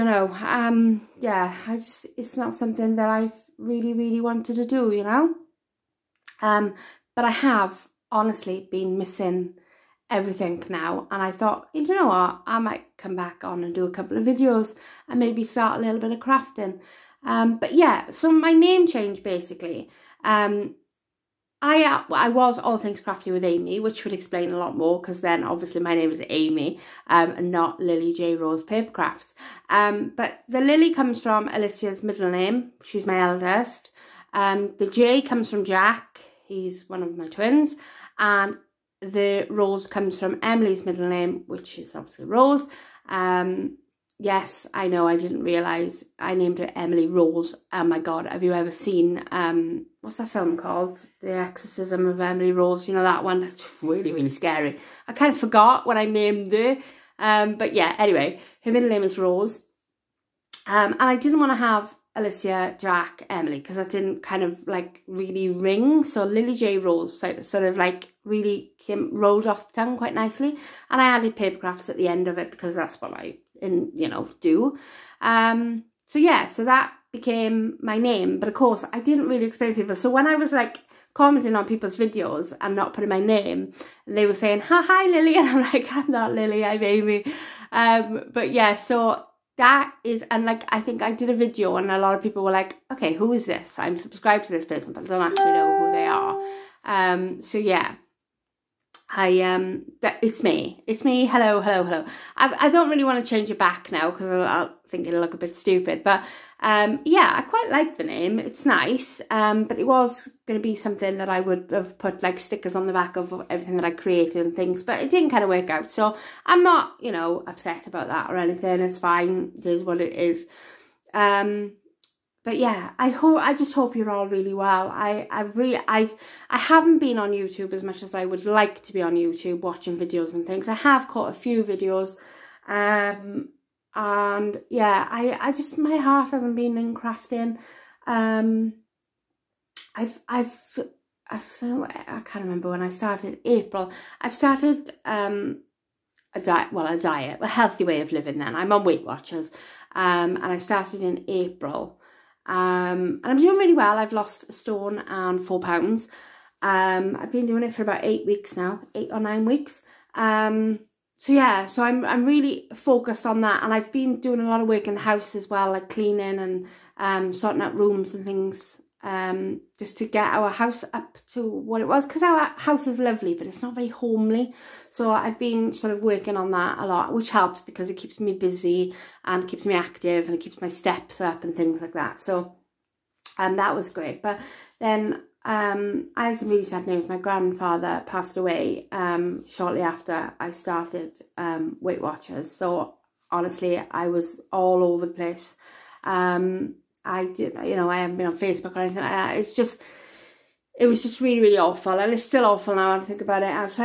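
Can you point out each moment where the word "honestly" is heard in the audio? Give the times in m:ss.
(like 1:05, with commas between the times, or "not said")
0:08, 3:13.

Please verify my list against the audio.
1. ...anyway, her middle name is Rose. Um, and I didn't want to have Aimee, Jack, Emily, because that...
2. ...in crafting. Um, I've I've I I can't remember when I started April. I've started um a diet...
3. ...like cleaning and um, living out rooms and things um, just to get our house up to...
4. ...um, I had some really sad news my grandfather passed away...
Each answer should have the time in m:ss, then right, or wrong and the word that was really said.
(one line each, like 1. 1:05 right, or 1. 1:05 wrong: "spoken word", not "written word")
1. 0:57 wrong: "Alicia", not "Aimee"
2. 2:16 right
3. 2:45 wrong: "sorting", not "living"
4. 3:05 right.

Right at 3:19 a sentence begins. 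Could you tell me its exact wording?
It's just, it was just really, really awful.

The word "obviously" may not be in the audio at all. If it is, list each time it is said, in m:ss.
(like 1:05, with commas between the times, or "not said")
0:25, 0:41.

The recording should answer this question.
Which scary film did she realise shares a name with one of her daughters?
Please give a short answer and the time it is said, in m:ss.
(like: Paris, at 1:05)
The Exorcism of Emily Rose, at 0:51.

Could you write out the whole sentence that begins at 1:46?
But um, yeah, I quite like the name.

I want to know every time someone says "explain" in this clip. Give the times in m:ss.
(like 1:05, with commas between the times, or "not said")
0:24, 1:19.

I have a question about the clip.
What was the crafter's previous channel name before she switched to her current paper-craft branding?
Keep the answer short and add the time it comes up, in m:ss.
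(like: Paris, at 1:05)
All Things Crafty with Aimee, at 0:22.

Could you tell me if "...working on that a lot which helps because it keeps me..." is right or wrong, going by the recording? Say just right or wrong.
right.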